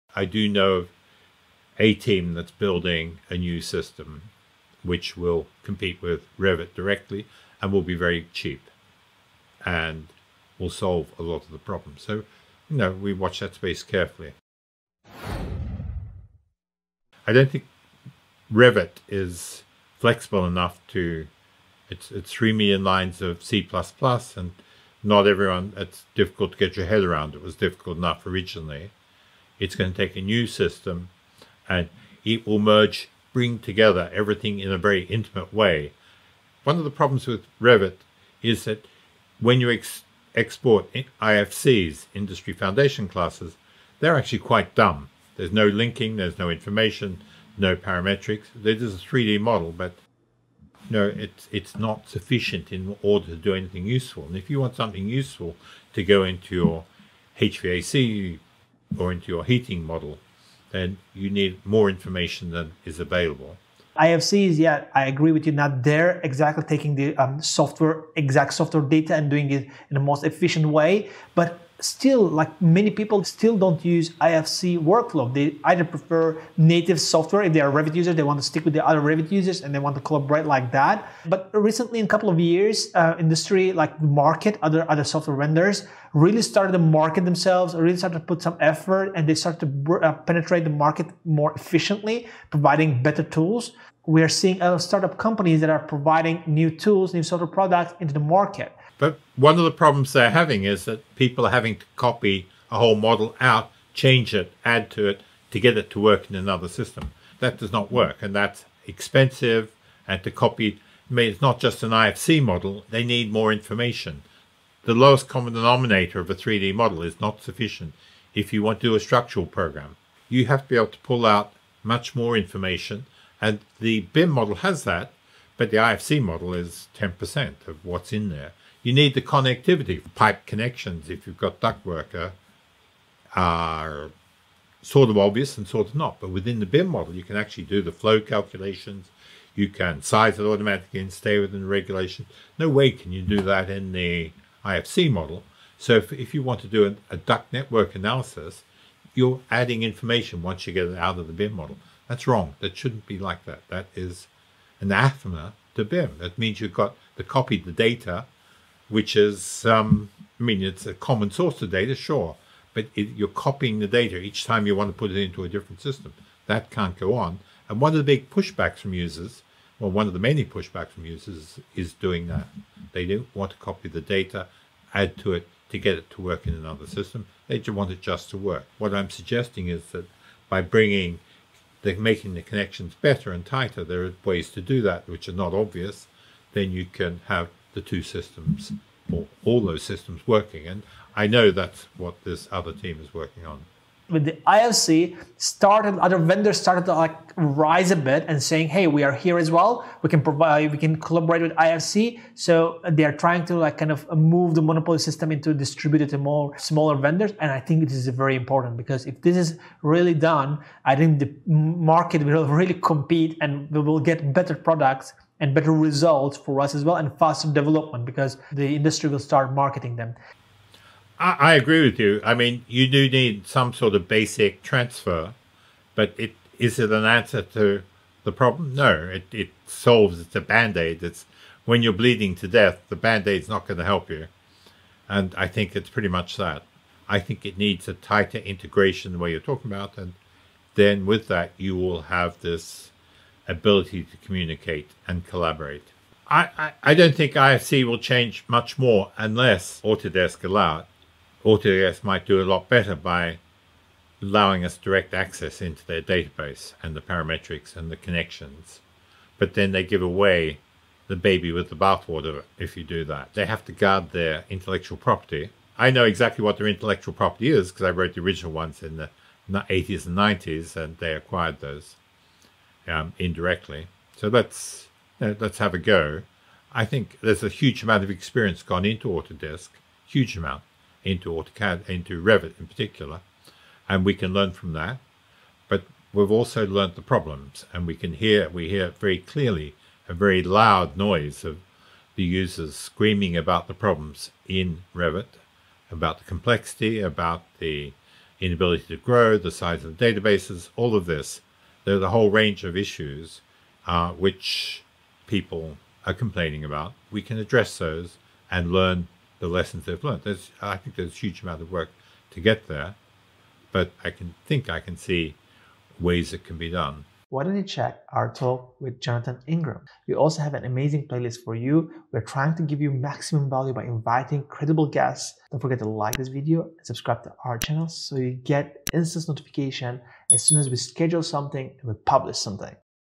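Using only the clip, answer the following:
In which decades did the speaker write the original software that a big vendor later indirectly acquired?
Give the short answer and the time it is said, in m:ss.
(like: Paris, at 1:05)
80s and 90s, at 4:29.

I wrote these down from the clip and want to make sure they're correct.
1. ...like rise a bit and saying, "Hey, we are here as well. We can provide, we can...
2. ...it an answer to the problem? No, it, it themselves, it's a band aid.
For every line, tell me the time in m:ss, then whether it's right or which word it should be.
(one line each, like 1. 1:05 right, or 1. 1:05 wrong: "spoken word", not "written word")
1. 3:16 right
2. 3:46 wrong: "solves", not "themselves".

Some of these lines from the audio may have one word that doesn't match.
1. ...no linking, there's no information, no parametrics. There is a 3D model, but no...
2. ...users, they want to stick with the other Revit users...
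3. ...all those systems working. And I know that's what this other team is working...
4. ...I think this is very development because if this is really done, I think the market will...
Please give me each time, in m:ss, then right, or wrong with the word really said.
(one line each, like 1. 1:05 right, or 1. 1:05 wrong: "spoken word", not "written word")
1. 0:45 right
2. 1:17 right
3. 3:09 right
4. 3:27 wrong: "important", not "development".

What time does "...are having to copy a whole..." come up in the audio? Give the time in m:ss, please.
1:41.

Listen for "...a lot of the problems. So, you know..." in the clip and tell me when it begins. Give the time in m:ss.
0:11.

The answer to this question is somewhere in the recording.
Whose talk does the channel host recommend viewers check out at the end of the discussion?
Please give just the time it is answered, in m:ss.
5:18.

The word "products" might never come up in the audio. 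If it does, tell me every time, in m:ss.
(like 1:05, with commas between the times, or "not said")
1:37, 3:34.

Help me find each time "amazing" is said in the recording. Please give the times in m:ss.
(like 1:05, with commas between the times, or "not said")
5:20.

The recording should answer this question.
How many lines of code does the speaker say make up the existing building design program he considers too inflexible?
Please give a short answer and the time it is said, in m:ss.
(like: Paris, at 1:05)
3 million, at 0:22.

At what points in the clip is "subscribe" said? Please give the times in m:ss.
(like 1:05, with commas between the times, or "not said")
5:26.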